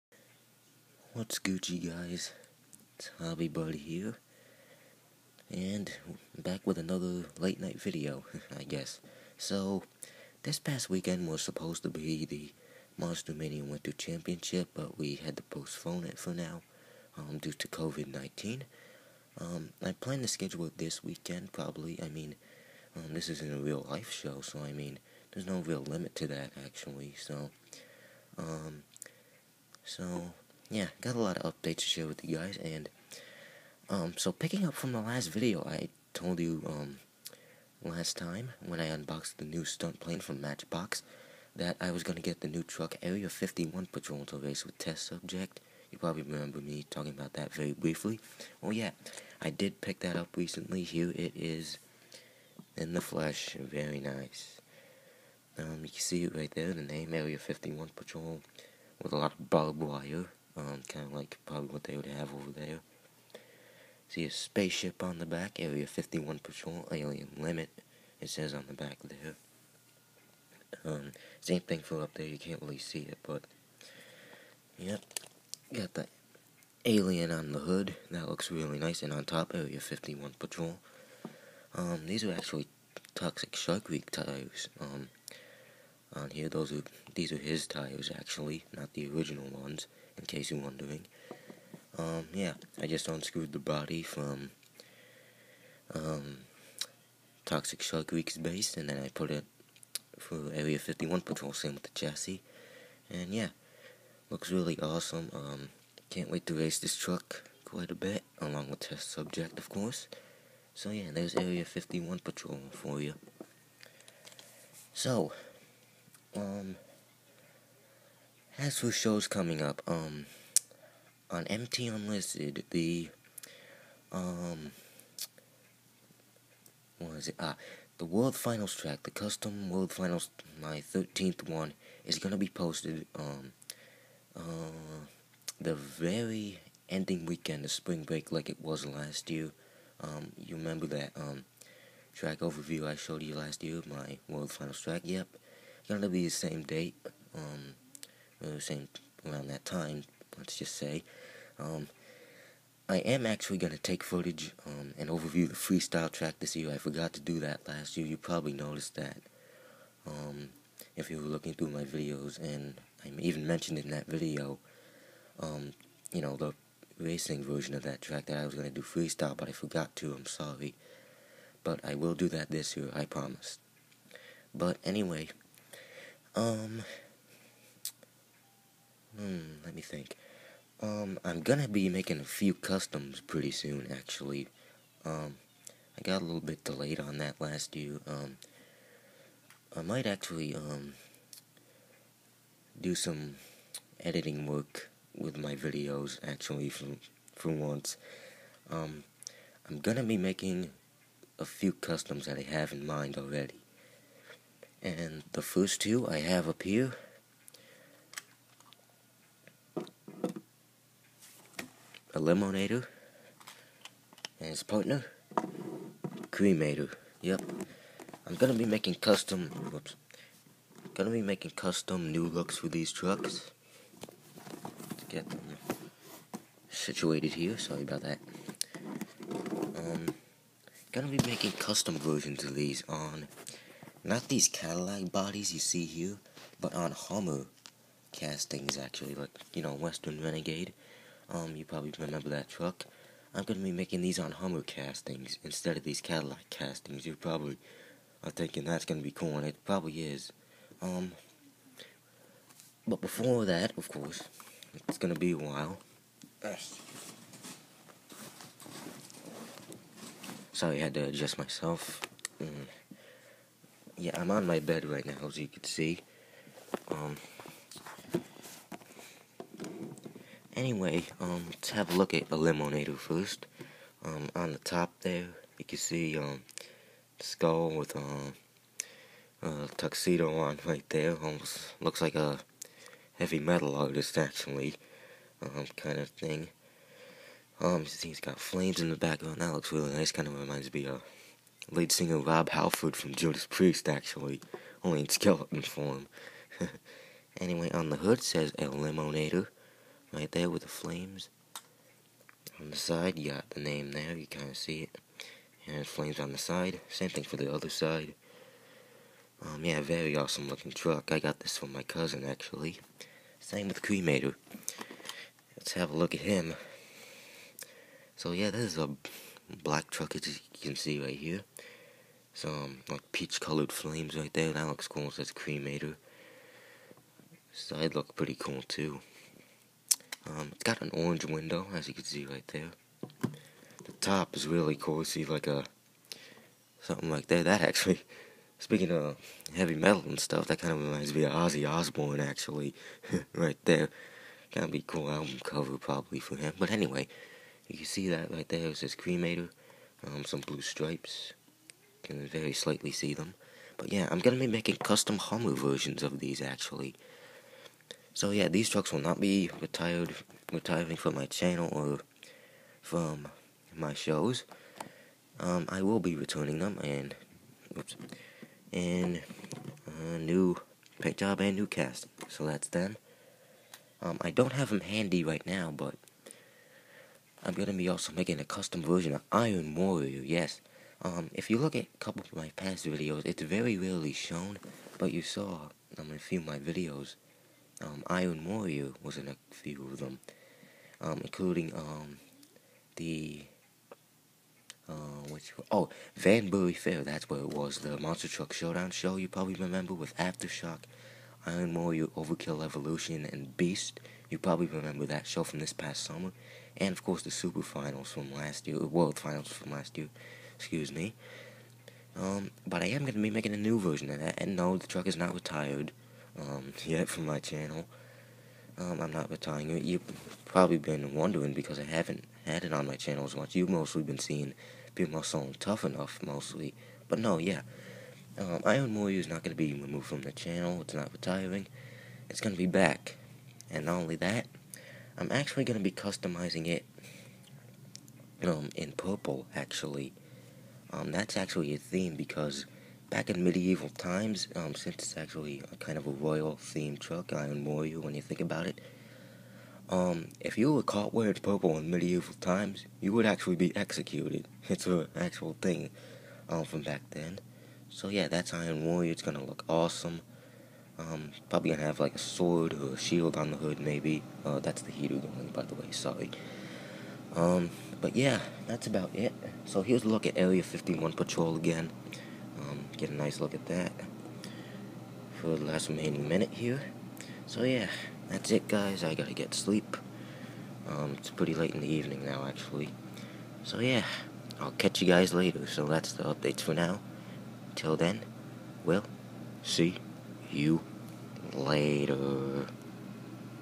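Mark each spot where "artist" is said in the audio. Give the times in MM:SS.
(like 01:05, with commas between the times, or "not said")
04:43.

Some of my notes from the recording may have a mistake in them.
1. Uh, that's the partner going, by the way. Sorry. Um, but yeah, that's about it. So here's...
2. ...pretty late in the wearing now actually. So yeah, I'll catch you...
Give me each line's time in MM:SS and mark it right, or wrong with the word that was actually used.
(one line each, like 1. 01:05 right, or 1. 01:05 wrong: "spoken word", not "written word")
1. 07:44 wrong: "heater", not "partner"
2. 08:01 wrong: "evening", not "wearing".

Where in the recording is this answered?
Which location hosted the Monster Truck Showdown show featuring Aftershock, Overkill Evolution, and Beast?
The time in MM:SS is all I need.
06:36.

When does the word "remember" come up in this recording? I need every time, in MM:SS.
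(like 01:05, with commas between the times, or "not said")
00:46, 02:20, 04:01, 06:39, 06:44.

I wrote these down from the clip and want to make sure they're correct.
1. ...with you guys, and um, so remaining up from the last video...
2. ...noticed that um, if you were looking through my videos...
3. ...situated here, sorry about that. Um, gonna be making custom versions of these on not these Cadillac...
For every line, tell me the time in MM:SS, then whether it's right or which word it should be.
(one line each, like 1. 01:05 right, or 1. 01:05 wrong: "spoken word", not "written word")
1. 00:32 wrong: "picking", not "remaining"
2. 02:38 right
3. 03:46 right.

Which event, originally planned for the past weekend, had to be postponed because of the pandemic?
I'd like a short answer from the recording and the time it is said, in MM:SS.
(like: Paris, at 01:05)
Monster Mania Winter Championship, at 00:12.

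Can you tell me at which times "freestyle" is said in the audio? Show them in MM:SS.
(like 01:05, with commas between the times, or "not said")
02:35, 02:48.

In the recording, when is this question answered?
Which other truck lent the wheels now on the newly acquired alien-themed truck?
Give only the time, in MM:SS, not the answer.
01:23.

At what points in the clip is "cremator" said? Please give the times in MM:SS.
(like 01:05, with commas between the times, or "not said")
03:36, 05:13, 05:25, 05:48.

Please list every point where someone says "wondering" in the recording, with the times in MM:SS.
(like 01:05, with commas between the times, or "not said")
01:30, 07:01.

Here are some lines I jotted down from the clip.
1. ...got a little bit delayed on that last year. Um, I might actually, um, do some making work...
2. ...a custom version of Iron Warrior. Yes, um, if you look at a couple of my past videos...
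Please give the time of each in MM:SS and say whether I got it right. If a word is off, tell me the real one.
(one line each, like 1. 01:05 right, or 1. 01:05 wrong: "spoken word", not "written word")
1. 03:06 wrong: "editing", not "making"
2. 06:18 right.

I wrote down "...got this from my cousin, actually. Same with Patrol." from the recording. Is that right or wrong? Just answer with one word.
wrong.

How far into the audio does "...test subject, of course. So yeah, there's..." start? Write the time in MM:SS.
01:48.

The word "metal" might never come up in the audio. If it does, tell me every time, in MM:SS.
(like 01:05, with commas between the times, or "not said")
04:43, 05:39.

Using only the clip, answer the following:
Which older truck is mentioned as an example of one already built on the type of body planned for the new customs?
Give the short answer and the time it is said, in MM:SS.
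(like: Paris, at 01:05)
Western Renegade, at 03:59.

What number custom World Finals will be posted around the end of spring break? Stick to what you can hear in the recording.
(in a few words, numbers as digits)
13th.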